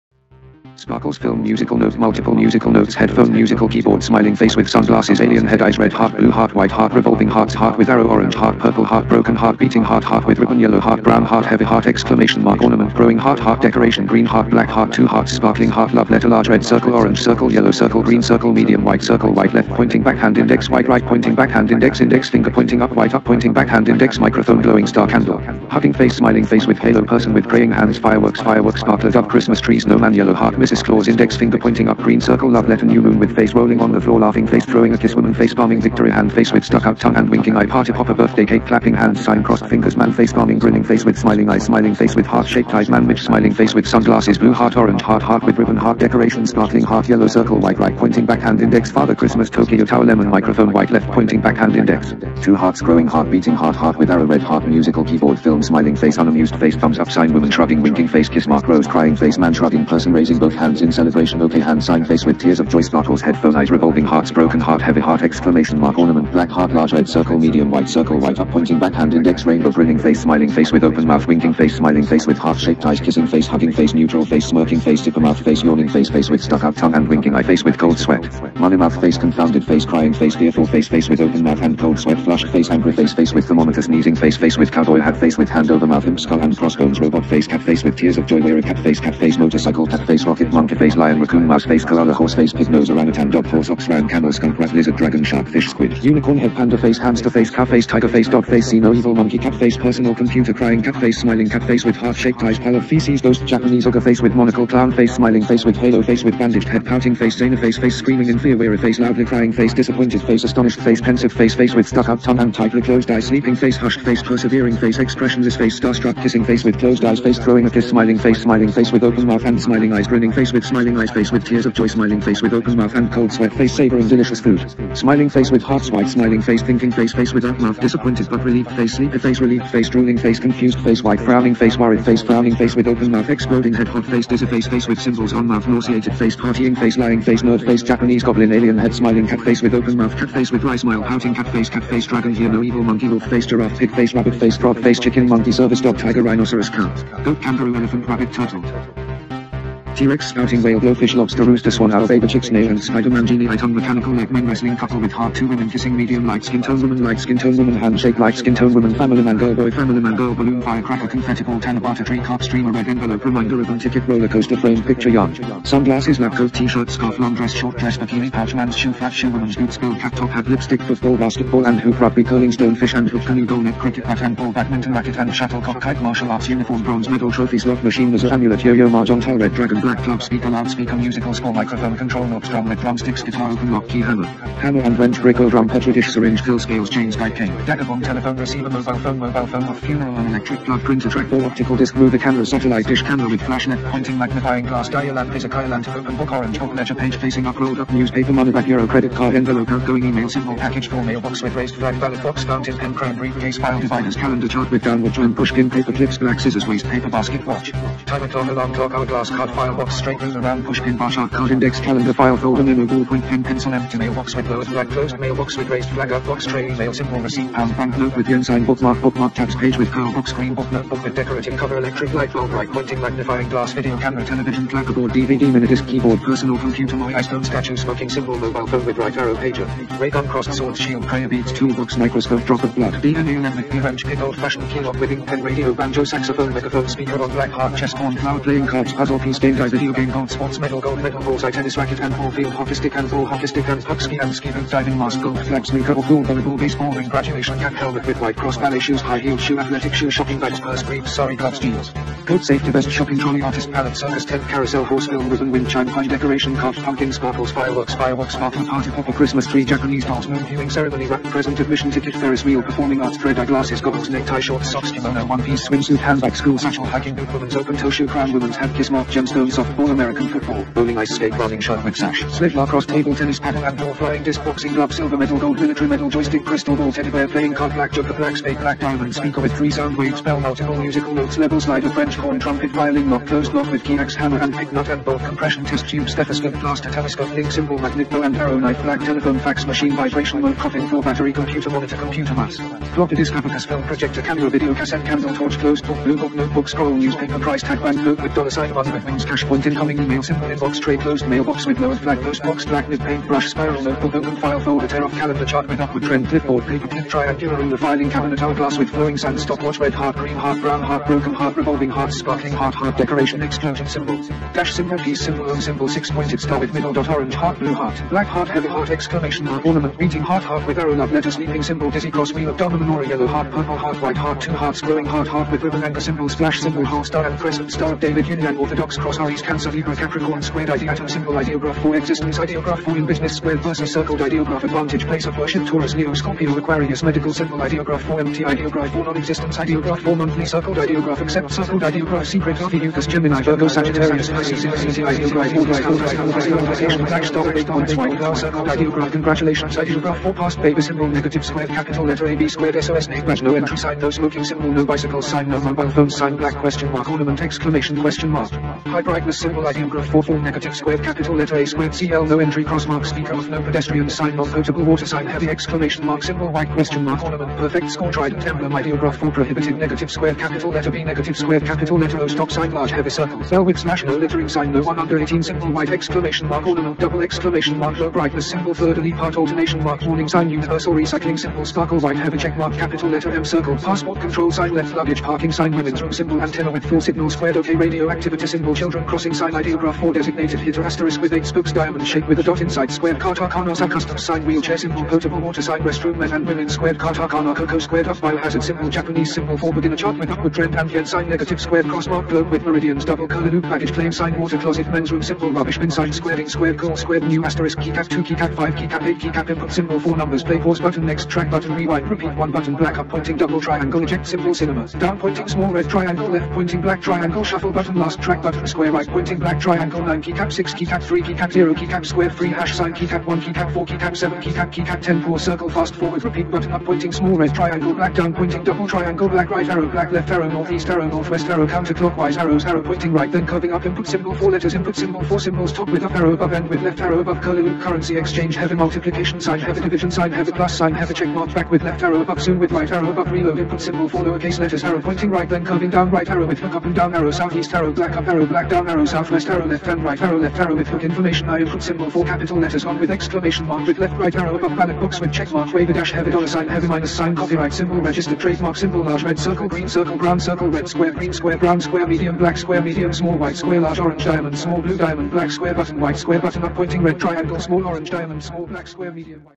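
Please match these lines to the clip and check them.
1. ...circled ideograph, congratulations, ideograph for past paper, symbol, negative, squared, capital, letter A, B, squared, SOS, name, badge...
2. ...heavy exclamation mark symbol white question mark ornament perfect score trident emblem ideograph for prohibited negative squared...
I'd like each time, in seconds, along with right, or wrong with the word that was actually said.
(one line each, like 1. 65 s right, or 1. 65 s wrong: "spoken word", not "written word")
1. 348 s right
2. 365 s right.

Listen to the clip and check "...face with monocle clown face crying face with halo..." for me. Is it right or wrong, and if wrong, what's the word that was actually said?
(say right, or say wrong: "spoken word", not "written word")
wrong: "smiling", not "crying".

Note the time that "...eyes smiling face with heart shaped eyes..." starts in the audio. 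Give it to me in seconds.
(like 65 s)
41 s.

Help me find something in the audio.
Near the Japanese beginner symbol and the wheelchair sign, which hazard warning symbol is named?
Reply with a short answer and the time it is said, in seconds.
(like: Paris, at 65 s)
Biohazard symbol, at 398 s.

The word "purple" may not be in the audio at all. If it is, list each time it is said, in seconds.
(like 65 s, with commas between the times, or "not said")
8 s, 323 s.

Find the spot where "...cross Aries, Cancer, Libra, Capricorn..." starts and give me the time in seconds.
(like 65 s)
328 s.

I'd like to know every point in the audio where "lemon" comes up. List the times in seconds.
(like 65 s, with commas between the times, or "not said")
50 s, 233 s.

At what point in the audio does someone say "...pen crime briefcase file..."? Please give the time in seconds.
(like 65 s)
202 s.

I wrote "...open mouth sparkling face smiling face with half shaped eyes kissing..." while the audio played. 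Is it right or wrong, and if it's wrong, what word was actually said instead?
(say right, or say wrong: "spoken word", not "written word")
wrong: "winking", not "sparkling".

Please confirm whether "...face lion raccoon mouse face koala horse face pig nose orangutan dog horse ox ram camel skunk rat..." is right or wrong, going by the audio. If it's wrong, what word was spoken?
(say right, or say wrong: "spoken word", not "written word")
right.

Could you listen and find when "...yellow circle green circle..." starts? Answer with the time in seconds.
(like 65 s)
17 s.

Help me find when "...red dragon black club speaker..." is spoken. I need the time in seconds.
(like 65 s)
179 s.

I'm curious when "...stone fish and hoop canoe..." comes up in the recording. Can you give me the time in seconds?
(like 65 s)
172 s.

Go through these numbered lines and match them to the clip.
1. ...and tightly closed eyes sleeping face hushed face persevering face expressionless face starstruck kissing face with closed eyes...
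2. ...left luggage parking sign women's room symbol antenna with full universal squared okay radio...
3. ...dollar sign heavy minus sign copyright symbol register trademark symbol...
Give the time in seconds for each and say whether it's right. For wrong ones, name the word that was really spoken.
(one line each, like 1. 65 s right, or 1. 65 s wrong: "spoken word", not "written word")
1. 112 s right
2. 384 s wrong: "signal", not "universal"
3. 456 s right.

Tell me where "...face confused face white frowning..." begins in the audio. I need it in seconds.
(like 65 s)
130 s.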